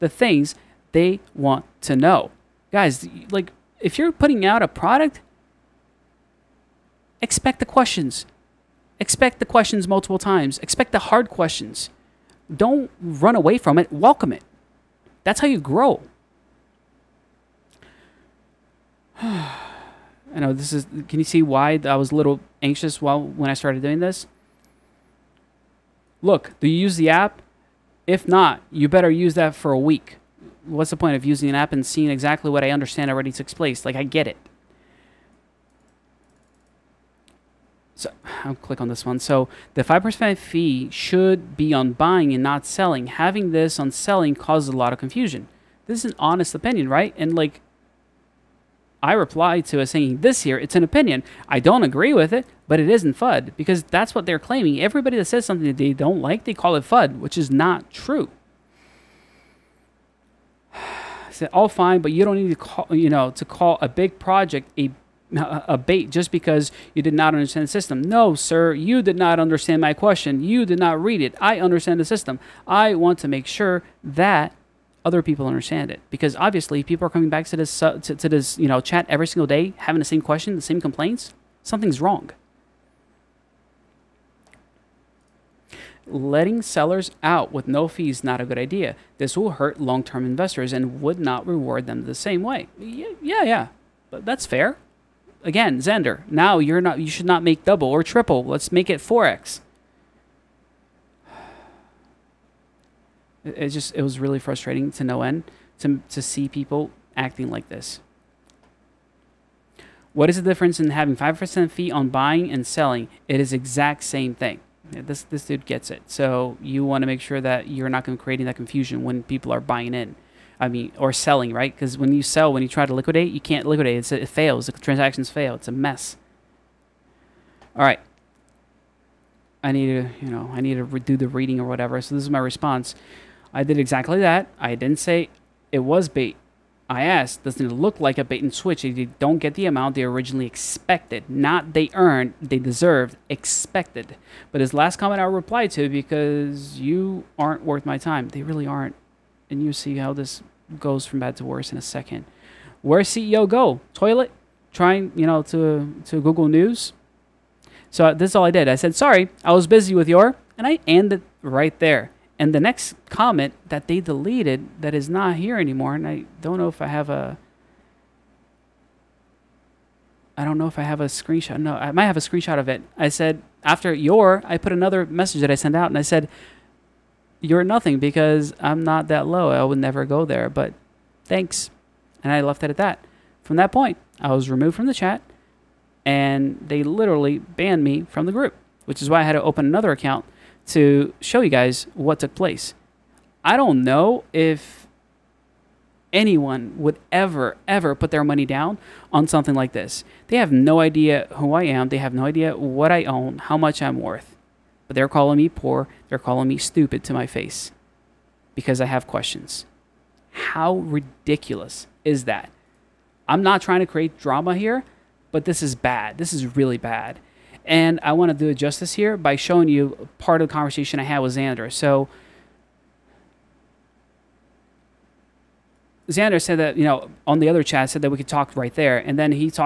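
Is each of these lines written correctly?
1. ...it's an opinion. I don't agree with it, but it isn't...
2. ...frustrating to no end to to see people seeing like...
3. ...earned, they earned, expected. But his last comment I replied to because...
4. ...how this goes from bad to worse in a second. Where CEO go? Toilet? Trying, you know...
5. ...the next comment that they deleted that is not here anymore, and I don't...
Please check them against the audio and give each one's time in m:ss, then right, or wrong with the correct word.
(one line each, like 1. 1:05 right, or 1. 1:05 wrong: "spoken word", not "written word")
1. 0:50 right
2. 1:44 wrong: "acting", not "seeing"
3. 2:21 wrong: "deserved", not "earned"
4. 2:29 right
5. 2:42 right.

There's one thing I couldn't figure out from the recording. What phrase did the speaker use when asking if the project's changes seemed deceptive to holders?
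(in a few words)
bait and switch.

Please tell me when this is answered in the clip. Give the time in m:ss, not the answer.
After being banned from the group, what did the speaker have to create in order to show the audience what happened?
3:09.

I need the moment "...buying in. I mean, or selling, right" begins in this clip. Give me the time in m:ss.
1:59.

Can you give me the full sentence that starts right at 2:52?
I said, after your, I put another message that I sent out, and I said, you're nothing because I'm not that low.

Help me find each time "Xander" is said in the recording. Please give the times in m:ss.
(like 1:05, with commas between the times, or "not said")
1:35, 3:41, 3:46.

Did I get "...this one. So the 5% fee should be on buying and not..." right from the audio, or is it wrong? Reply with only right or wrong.
right.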